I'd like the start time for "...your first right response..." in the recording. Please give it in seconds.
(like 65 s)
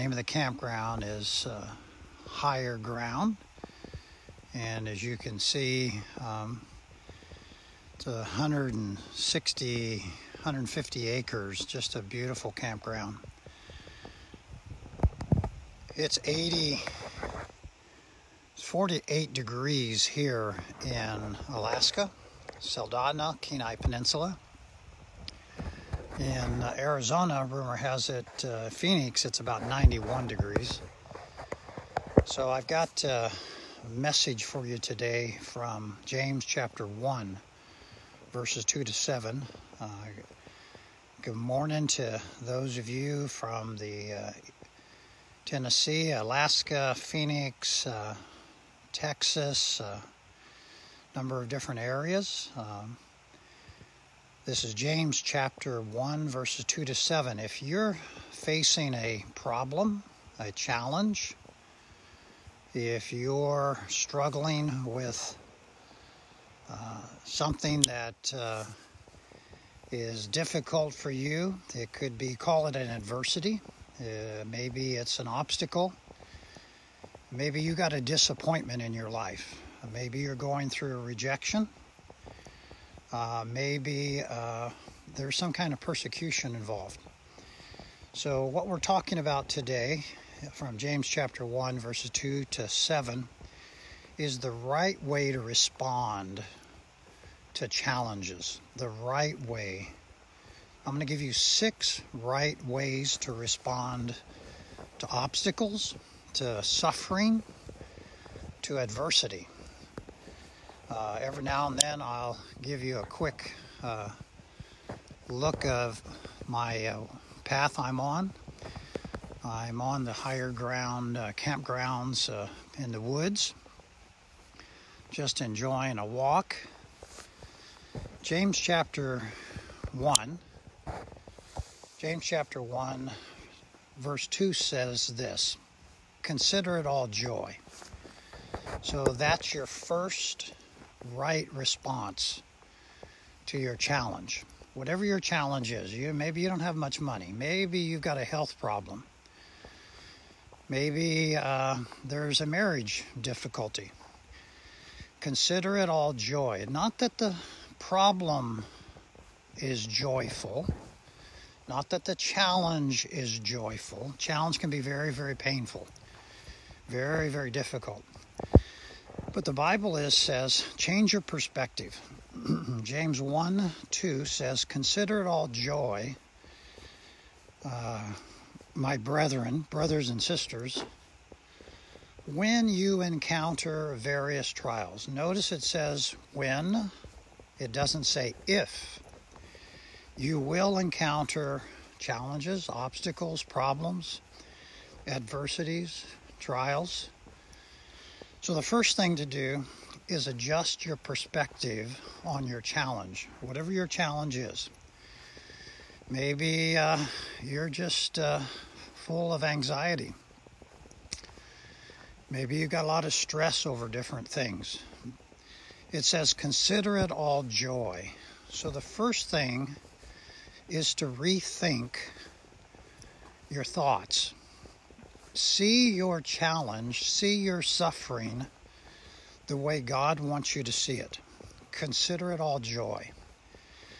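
139 s.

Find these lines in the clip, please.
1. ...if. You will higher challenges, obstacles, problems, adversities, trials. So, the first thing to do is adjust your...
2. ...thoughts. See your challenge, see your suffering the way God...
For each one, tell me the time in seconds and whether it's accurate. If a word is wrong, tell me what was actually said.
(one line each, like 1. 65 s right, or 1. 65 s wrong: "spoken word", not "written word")
1. 188 s wrong: "encounter", not "higher"
2. 223 s right.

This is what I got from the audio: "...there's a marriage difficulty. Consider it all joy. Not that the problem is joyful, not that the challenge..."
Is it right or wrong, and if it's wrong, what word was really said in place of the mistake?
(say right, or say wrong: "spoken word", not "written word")
right.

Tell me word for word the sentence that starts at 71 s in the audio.
It could be, call it an adversity.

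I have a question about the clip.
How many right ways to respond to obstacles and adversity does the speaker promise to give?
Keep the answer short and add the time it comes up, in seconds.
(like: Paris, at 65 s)
6, at 101 s.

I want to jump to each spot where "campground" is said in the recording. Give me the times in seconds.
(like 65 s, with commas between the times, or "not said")
0 s, 12 s, 121 s.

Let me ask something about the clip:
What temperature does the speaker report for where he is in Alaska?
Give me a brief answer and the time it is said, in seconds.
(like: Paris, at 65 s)
48 degrees, at 18 s.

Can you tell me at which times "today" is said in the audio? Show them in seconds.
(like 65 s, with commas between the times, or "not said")
34 s, 89 s.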